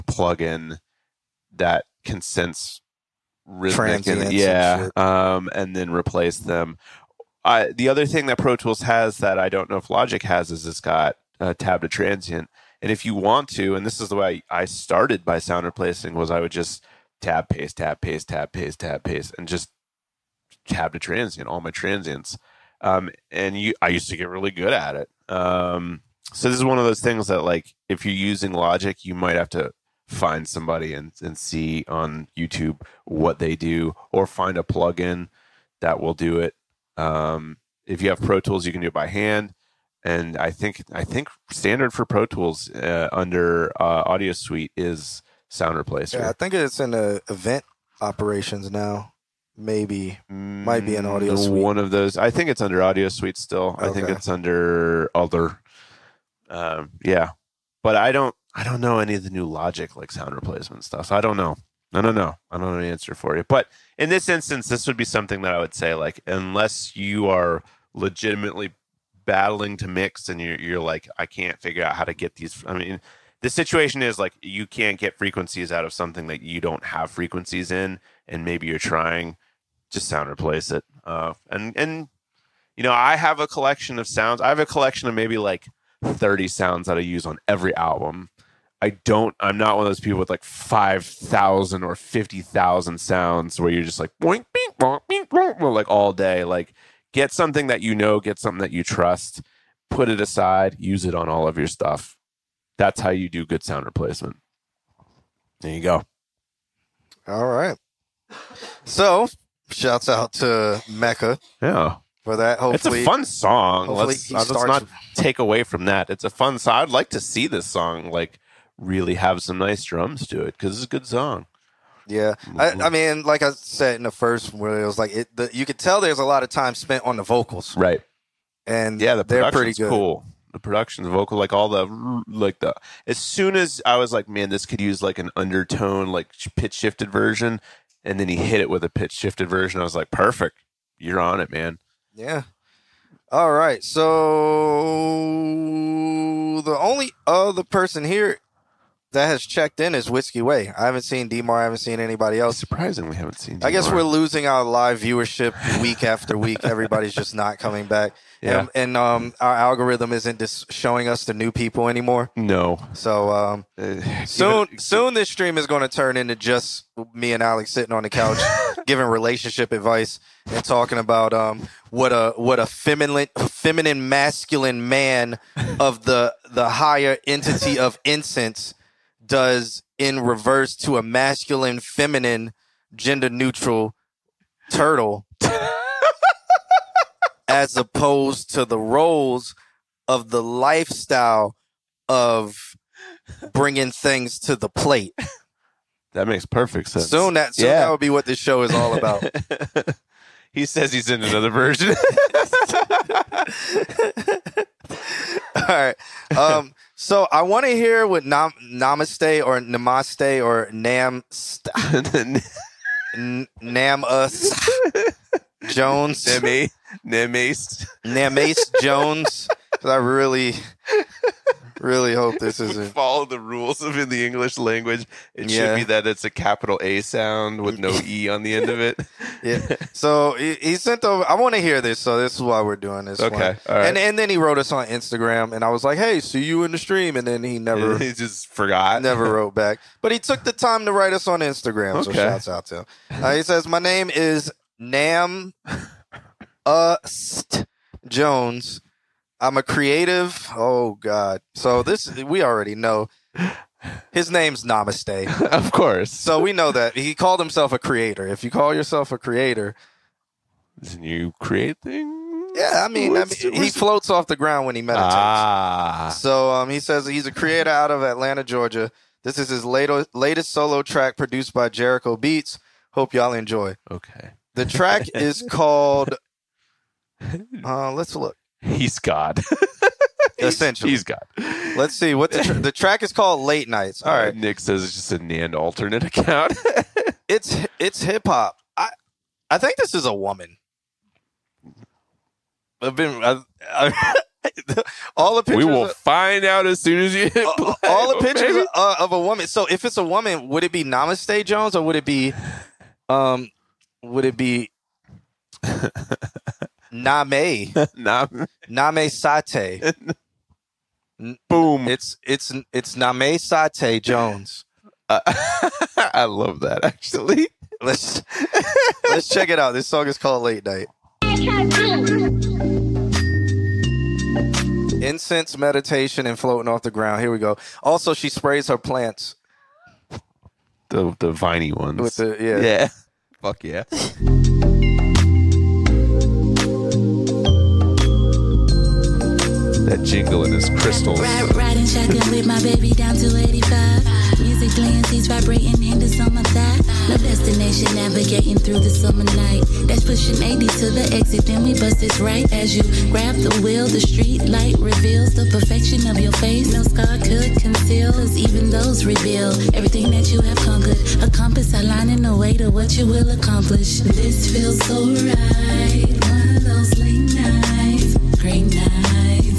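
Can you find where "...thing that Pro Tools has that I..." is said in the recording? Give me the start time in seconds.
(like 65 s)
8 s.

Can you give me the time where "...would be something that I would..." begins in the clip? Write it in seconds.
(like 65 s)
64 s.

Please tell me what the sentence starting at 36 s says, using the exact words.
Um, if you have Pro Tools, you can do it by hand.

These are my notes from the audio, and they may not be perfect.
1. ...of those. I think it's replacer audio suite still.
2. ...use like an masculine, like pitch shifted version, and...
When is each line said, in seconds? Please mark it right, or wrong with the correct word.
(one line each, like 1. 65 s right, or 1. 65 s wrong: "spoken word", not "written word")
1. 51 s wrong: "under", not "replacer"
2. 134 s wrong: "undertone", not "masculine".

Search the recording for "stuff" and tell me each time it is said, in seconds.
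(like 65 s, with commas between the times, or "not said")
60 s, 101 s.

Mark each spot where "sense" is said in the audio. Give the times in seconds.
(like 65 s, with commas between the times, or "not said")
2 s, 196 s.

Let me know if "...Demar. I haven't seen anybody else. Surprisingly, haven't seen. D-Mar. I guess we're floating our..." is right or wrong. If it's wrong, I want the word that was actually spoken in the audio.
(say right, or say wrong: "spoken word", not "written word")
wrong: "losing", not "floating".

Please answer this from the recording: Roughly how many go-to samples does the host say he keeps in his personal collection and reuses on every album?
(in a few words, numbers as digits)
30.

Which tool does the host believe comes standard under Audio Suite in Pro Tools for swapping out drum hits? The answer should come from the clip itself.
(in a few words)
Sound Replacer.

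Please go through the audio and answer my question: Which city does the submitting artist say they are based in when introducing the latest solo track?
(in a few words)
Atlanta.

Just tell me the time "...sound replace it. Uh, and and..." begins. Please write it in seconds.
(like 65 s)
79 s.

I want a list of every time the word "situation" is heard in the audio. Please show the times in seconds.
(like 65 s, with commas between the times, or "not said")
73 s.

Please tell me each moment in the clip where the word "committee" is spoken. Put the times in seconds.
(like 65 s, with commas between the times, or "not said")
not said.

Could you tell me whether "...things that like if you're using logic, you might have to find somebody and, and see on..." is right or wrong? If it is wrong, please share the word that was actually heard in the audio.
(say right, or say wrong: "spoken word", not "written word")
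right.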